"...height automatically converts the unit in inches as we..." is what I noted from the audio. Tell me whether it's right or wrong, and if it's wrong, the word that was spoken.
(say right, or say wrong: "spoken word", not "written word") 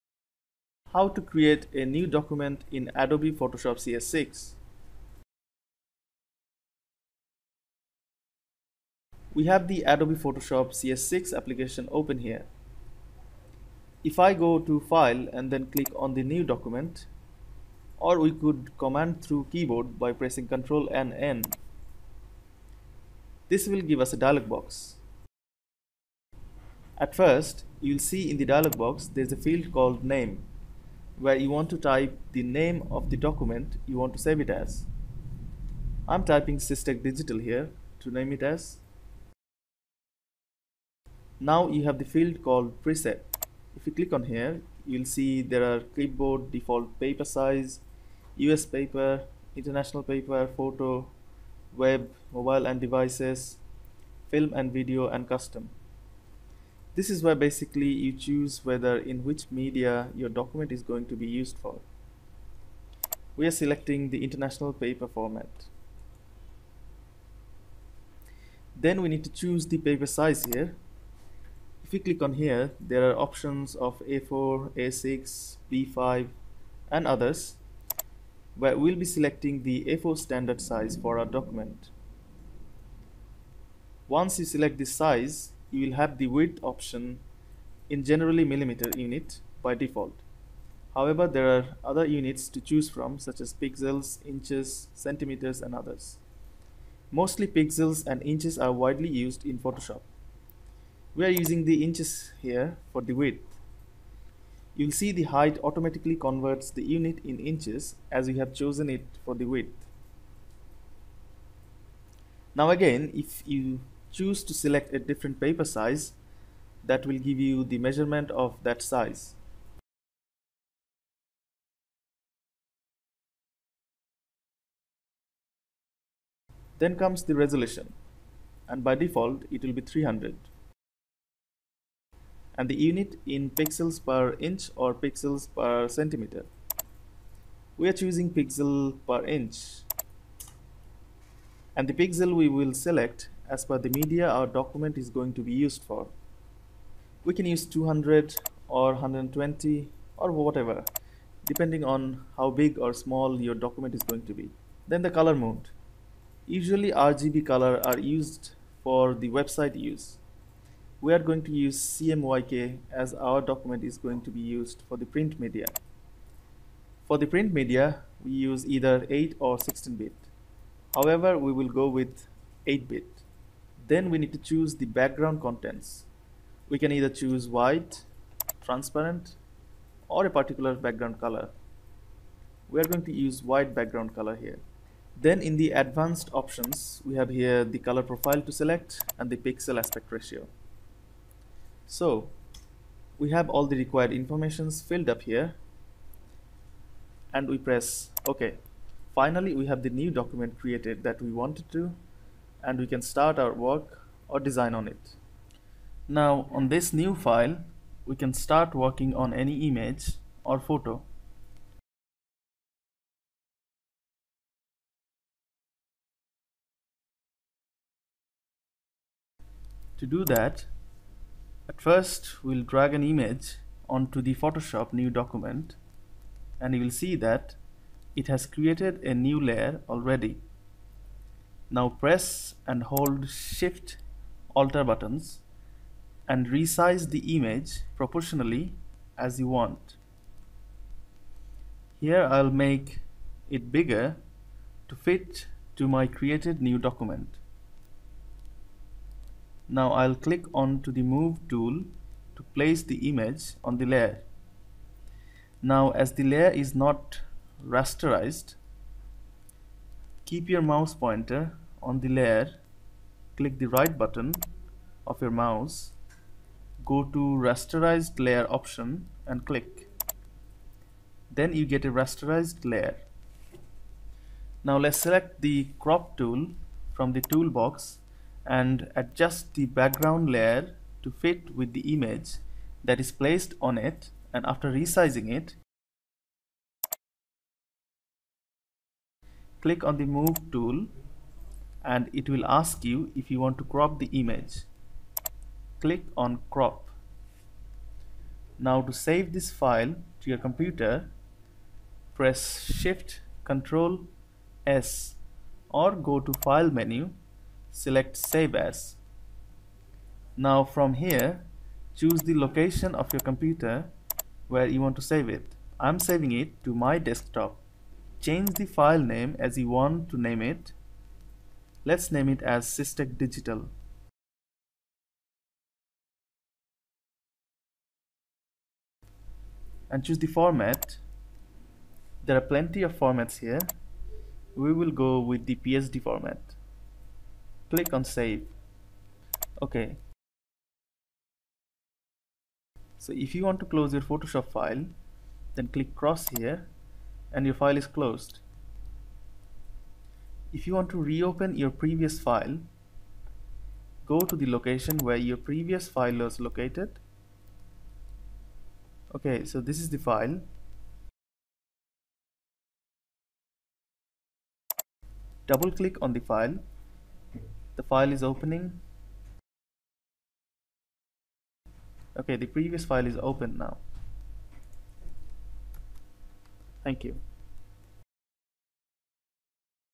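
right.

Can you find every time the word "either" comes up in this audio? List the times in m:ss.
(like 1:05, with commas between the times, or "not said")
2:48, 2:56.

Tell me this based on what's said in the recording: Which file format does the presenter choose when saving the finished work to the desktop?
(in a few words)
PSD.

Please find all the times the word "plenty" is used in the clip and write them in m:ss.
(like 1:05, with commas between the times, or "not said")
5:32.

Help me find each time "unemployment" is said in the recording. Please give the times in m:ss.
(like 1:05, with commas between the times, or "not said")
not said.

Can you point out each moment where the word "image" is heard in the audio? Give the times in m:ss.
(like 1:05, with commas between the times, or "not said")
3:29, 3:43, 3:57, 4:13, 4:41, 4:54.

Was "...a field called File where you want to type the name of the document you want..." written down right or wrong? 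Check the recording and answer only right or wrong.
wrong.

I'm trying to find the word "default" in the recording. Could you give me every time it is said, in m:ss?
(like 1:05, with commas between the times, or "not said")
0:46, 1:29, 2:08.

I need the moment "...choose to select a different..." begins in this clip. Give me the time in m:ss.
1:54.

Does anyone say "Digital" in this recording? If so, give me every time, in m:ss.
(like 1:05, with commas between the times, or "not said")
0:37, 5:23.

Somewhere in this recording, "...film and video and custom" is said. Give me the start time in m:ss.
0:54.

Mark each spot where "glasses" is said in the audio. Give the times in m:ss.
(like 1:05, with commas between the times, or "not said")
not said.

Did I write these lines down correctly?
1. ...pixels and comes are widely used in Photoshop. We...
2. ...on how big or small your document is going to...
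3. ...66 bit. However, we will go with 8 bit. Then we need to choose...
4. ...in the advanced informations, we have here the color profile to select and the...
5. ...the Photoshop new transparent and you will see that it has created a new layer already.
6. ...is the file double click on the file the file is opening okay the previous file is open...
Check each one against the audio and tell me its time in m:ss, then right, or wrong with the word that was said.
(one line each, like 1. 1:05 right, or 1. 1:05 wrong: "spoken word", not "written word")
1. 1:37 wrong: "inches", not "comes"
2. 2:31 right
3. 2:49 wrong: "16", not "66"
4. 3:05 wrong: "options", not "informations"
5. 3:44 wrong: "document", not "transparent"
6. 5:59 right.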